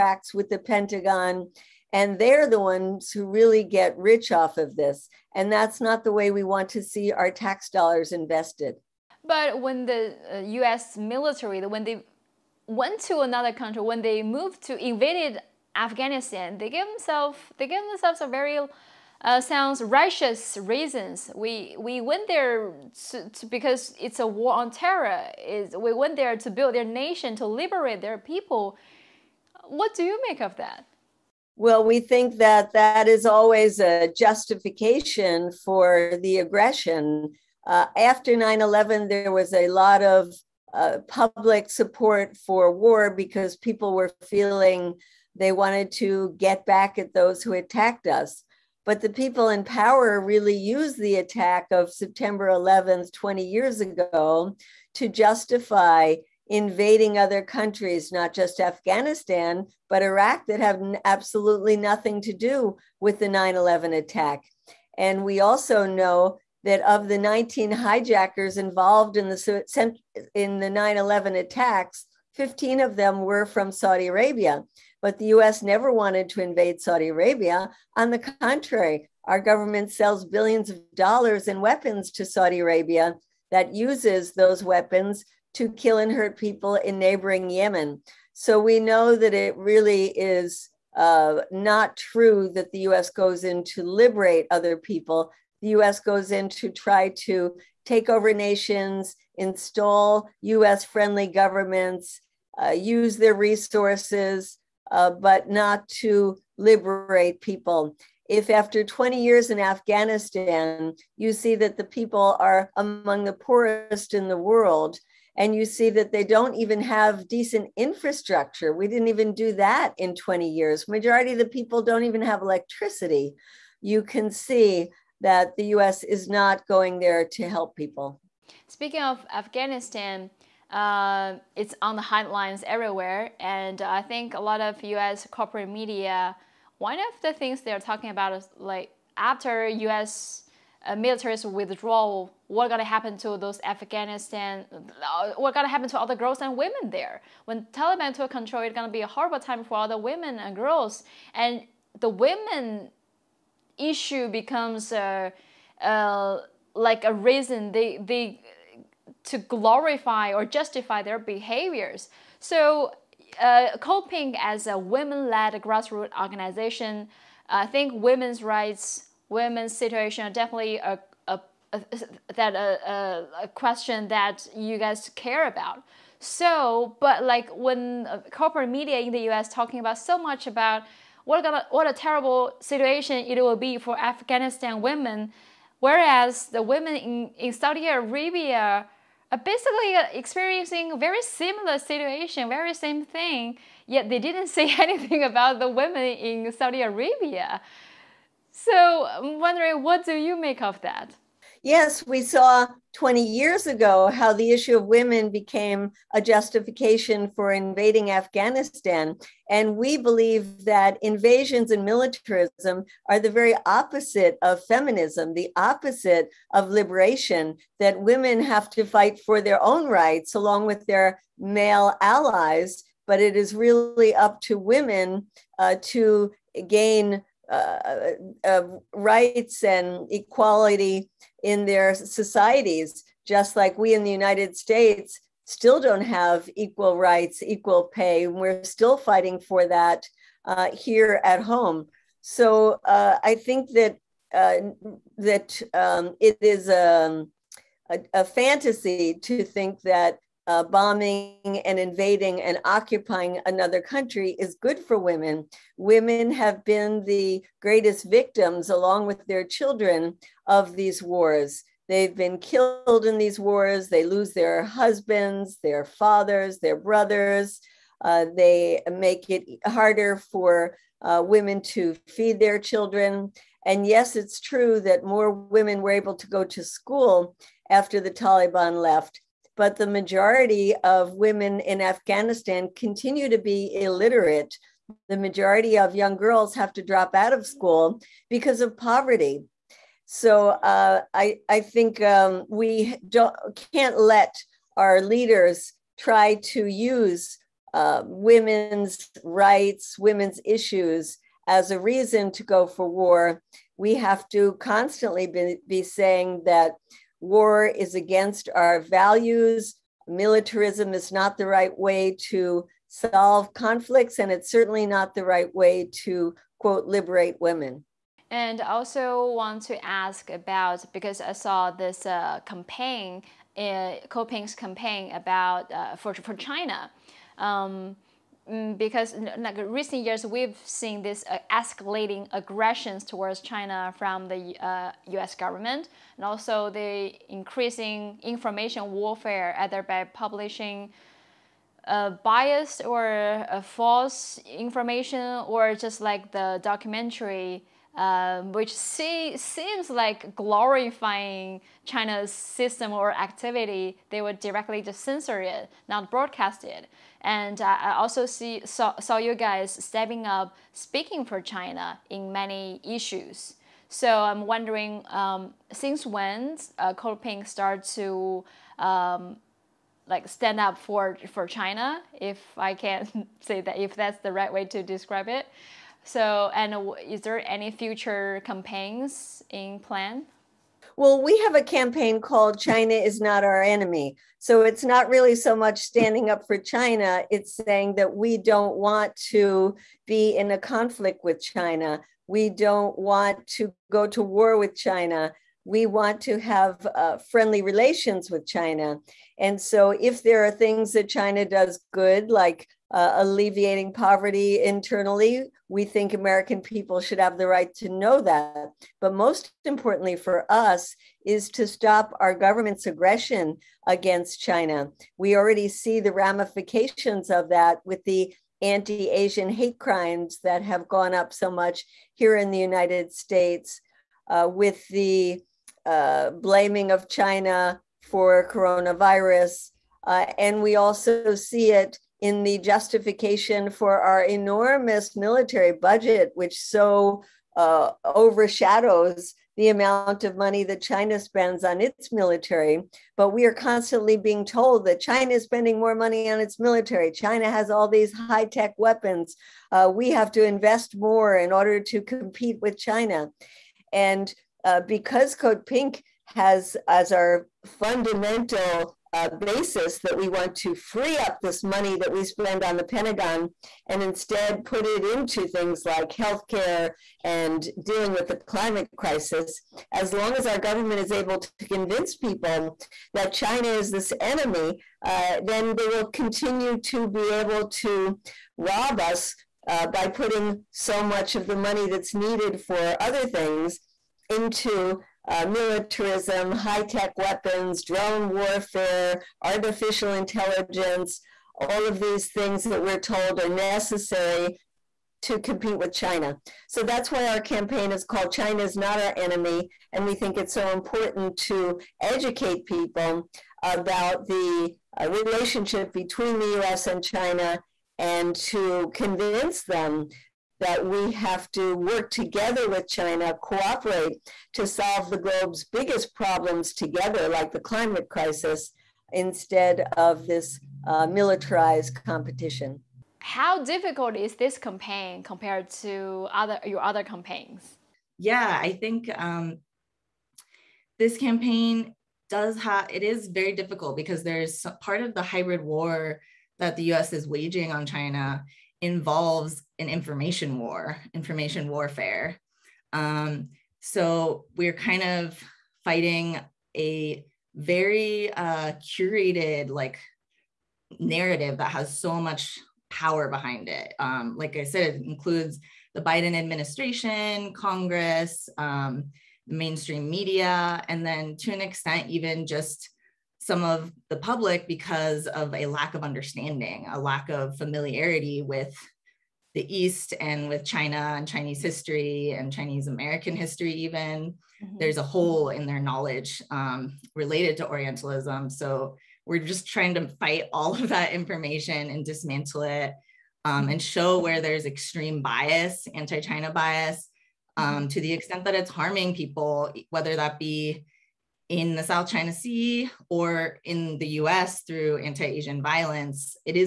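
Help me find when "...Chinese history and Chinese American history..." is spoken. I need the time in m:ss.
9:31.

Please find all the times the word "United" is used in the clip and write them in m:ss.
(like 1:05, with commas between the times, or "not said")
3:54, 7:02.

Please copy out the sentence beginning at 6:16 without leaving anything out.
So, and is there any future campaigns in plan?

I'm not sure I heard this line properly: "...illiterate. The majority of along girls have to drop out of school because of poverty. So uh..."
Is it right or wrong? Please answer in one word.
wrong.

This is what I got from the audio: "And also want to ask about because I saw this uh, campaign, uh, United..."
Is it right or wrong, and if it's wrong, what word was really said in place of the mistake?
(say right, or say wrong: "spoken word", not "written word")
wrong: "Code", not "United".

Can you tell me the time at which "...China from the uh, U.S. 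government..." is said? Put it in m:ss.
5:33.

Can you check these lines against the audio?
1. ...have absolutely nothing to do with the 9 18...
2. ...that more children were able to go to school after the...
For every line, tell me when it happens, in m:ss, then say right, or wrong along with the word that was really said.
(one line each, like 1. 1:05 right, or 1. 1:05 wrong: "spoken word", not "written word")
1. 1:00 wrong: "11", not "18"
2. 4:34 wrong: "women", not "children".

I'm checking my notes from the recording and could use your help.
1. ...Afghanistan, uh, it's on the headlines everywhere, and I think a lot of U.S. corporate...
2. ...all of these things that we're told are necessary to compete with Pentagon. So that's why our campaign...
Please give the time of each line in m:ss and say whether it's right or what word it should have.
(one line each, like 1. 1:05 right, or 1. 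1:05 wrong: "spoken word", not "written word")
1. 2:09 right
2. 8:11 wrong: "China", not "Pentagon".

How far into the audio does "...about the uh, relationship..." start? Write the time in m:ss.
8:23.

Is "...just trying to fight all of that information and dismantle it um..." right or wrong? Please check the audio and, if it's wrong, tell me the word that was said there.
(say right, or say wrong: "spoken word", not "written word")
right.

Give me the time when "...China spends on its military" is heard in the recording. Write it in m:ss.
7:20.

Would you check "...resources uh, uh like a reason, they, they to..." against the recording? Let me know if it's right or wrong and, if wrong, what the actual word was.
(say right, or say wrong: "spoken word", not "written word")
wrong: "becomes", not "resources".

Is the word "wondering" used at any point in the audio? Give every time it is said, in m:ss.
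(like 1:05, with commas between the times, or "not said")
3:19, 6:04.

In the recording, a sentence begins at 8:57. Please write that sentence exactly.
is waging on China involves an information war, information warfare.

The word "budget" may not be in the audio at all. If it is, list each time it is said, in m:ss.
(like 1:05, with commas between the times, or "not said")
7:15.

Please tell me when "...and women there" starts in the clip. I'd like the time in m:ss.
2:26.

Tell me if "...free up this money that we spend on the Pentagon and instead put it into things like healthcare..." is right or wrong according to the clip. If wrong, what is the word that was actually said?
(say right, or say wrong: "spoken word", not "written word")
right.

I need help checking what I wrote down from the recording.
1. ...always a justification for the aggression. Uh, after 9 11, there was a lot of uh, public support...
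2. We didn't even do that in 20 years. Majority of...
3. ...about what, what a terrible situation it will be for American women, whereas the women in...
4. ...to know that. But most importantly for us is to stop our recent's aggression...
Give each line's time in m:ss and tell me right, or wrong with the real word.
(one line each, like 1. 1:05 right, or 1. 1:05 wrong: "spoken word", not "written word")
1. 0:33 right
2. 1:58 right
3. 3:00 wrong: "Afghanistan", not "American"
4. 6:47 wrong: "government", not "recent".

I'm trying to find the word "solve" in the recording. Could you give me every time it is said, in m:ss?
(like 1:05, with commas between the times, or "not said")
5:12, 8:34.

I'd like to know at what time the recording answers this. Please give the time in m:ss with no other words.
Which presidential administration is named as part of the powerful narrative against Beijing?
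9:16.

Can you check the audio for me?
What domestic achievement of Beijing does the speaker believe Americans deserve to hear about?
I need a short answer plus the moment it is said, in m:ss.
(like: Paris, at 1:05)
alleviating poverty, at 6:43.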